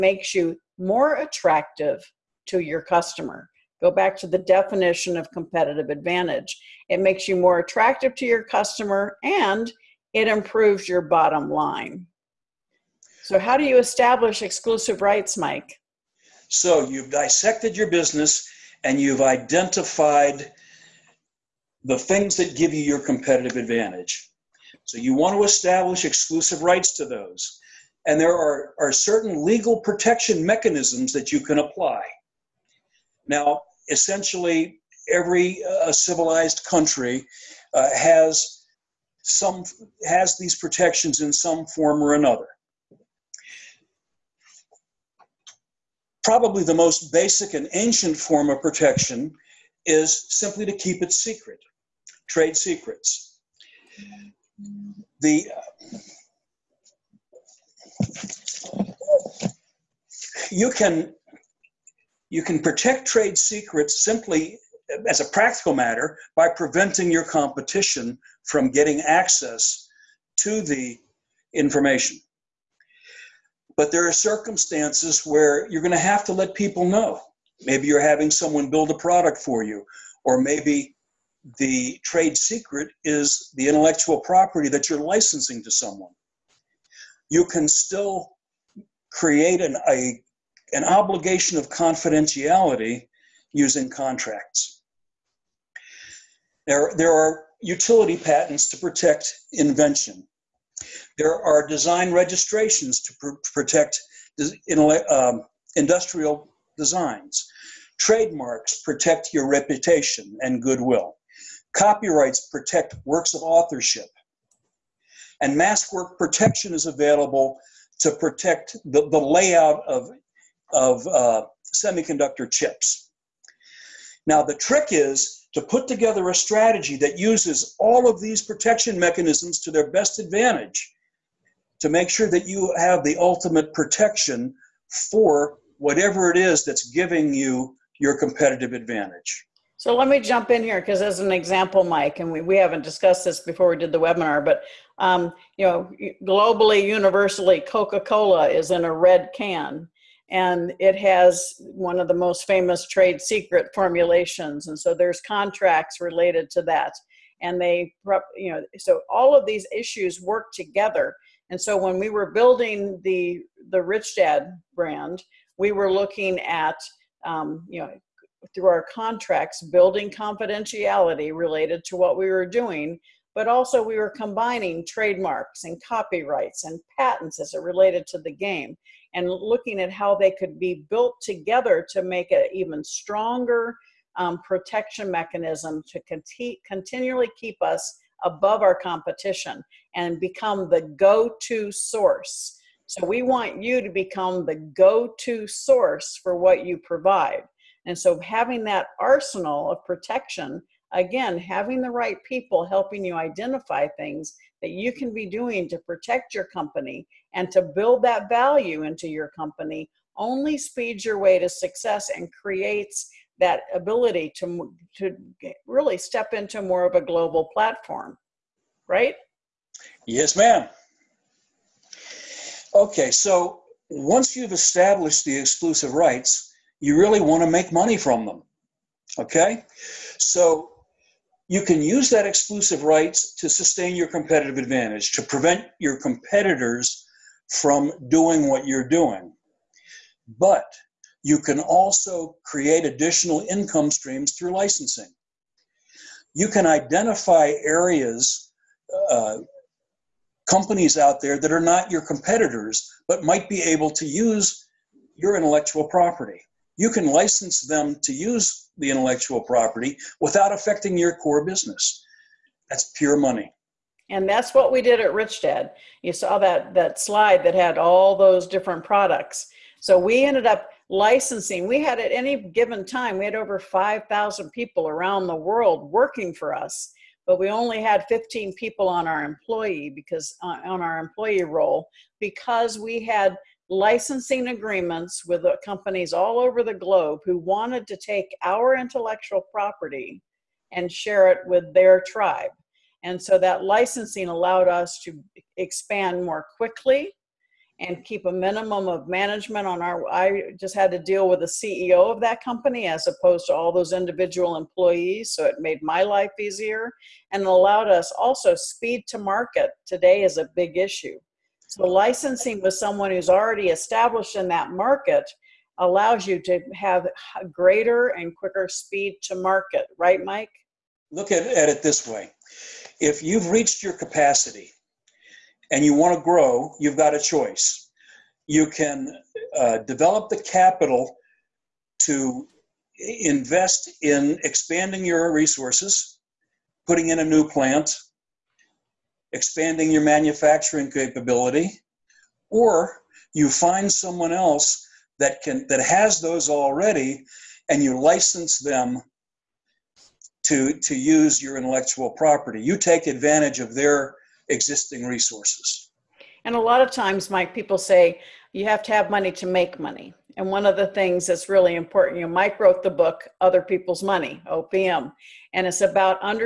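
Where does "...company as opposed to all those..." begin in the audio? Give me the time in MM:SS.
05:02.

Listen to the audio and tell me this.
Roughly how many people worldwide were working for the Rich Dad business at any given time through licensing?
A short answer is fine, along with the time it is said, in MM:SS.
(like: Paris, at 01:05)
5,000, at 04:33.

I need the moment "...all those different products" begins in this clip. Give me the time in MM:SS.
04:27.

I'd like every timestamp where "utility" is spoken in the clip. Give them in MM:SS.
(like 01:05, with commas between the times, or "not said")
01:37.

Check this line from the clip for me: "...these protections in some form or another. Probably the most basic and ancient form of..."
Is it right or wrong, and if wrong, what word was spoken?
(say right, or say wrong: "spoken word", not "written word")
right.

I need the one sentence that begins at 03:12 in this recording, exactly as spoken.
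So, we want you to become the go to source for what you provide.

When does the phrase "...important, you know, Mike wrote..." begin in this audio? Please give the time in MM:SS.
06:01.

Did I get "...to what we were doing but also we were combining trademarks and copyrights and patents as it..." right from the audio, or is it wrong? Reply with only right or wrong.
right.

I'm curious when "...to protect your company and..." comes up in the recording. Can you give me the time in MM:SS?
03:25.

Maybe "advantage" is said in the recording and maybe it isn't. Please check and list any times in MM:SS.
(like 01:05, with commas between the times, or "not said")
00:05, 00:23, 02:10, 02:18, 03:54, 05:53.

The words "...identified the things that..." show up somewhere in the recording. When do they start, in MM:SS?
00:19.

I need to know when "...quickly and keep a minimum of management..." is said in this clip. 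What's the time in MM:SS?
04:56.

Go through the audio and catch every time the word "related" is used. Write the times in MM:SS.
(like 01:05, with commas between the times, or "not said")
02:36, 02:51, 02:57.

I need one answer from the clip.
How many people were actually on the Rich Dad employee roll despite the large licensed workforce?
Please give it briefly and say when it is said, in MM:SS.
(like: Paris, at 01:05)
15, at 04:38.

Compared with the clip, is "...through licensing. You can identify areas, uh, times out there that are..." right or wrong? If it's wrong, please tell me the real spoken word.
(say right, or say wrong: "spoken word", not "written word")
wrong: "companies", not "times".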